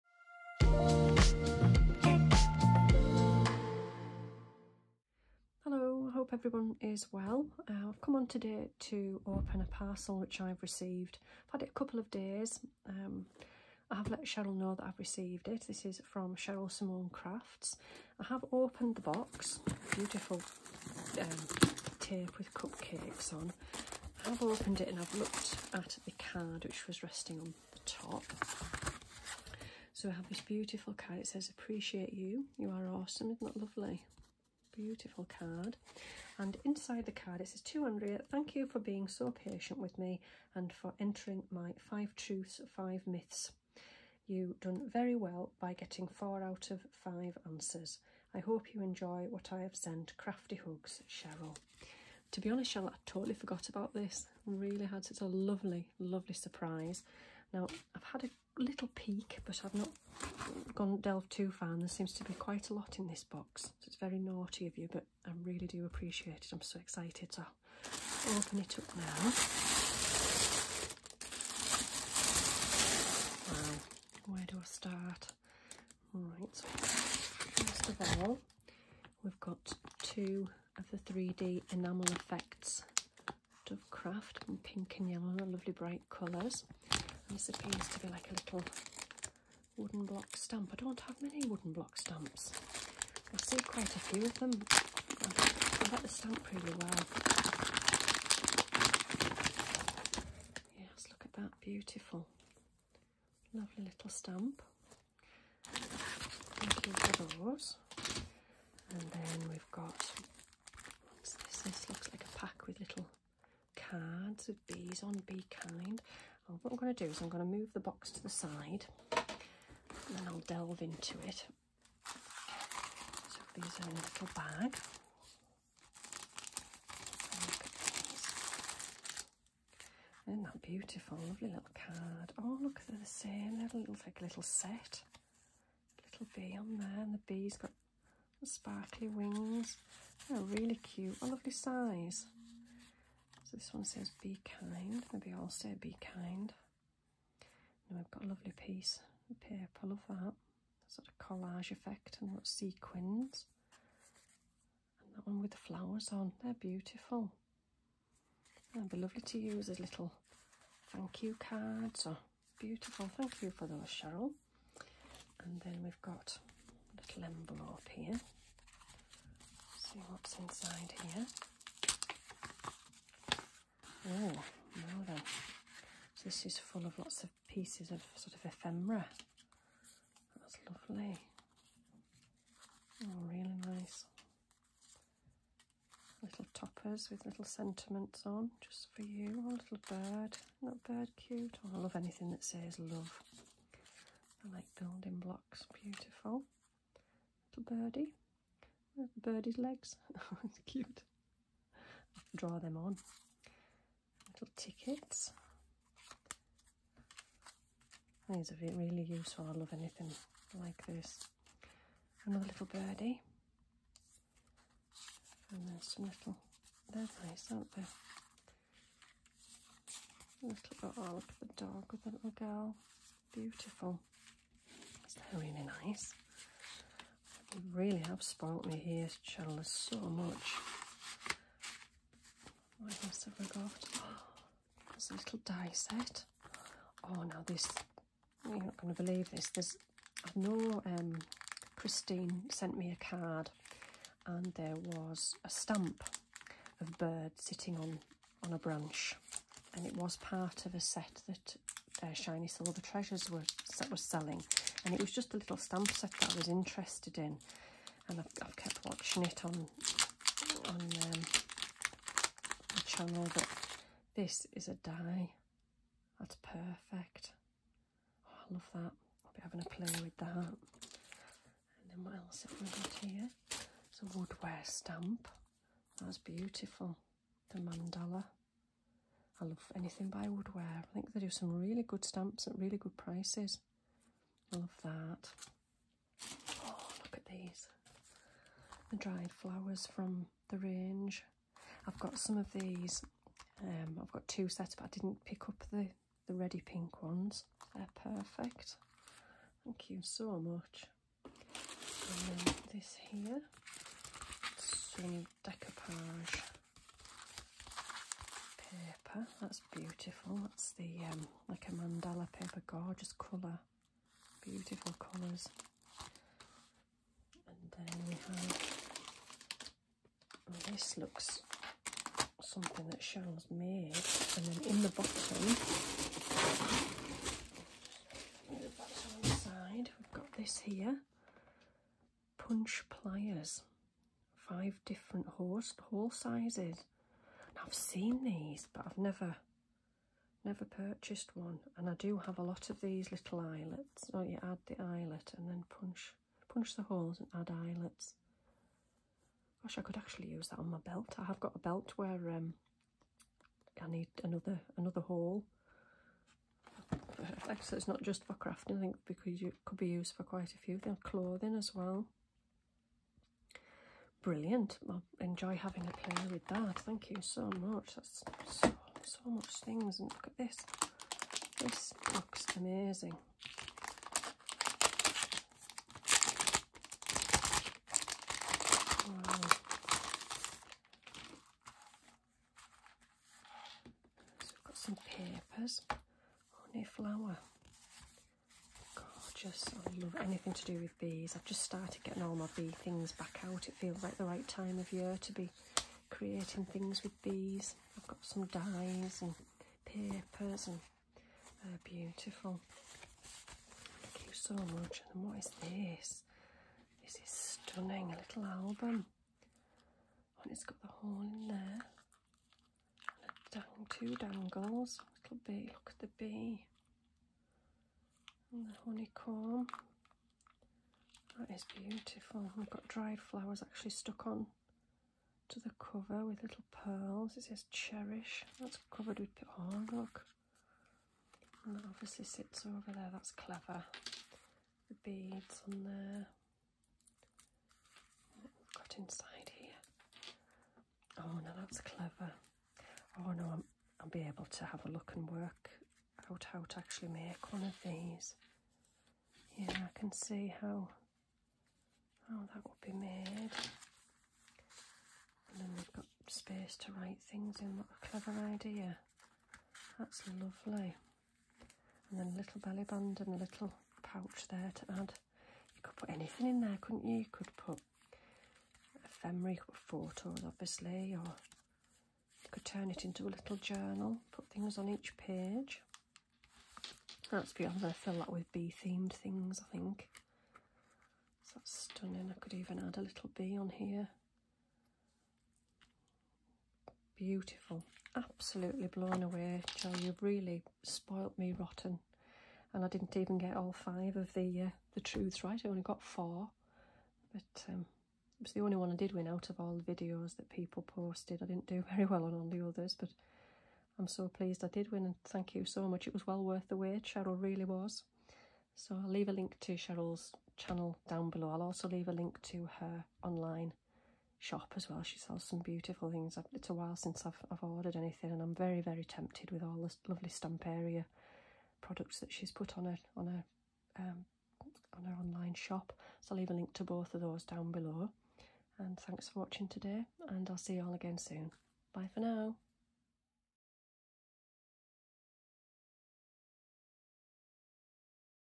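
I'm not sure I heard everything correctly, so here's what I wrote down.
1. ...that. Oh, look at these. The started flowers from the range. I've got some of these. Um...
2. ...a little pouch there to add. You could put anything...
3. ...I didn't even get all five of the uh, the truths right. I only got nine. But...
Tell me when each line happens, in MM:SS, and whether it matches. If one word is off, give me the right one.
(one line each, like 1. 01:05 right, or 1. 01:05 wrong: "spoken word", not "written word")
1. 04:44 wrong: "dried", not "started"
2. 07:43 right
3. 08:12 wrong: "four", not "nine".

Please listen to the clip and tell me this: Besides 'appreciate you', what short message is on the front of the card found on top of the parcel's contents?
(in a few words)
You are awesome.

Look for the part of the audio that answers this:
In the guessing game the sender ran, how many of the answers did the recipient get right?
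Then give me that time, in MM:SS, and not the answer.
00:46.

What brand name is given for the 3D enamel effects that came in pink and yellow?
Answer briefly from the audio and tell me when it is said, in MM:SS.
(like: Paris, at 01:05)
Dovecraft, at 01:23.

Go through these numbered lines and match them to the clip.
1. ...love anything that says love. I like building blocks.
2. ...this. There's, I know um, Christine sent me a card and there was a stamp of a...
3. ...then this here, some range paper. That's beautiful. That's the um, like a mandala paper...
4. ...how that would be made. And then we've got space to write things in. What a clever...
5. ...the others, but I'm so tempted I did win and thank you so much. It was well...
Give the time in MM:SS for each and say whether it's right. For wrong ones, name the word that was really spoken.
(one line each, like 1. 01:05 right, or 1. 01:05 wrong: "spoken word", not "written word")
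1. 03:11 right
2. 03:59 right
3. 05:02 wrong: "decoupage", not "range"
4. 07:32 right
5. 08:22 wrong: "pleased", not "tempted".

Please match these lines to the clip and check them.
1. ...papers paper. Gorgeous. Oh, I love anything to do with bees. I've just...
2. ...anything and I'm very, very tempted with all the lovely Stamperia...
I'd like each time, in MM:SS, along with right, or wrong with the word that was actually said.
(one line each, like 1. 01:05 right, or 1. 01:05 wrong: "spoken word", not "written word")
1. 06:25 wrong: "flower", not "paper"
2. 08:37 right.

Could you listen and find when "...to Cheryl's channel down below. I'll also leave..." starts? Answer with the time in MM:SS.
08:29.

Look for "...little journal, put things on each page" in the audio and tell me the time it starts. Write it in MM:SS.
07:53.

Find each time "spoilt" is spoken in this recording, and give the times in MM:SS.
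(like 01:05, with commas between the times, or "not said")
03:48, 08:10.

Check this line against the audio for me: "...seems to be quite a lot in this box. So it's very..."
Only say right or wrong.
right.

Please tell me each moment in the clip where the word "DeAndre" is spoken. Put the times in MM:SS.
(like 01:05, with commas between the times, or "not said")
not said.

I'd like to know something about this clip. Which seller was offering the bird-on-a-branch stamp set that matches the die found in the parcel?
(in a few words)
Shiny Silver Treasures.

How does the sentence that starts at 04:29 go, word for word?
I'll be having a play with that.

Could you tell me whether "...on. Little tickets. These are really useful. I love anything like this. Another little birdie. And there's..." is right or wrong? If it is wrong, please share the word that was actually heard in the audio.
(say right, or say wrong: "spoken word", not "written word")
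right.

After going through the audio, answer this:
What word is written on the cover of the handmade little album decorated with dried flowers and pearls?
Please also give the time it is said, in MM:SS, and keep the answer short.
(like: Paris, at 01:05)
Cherish, at 07:07.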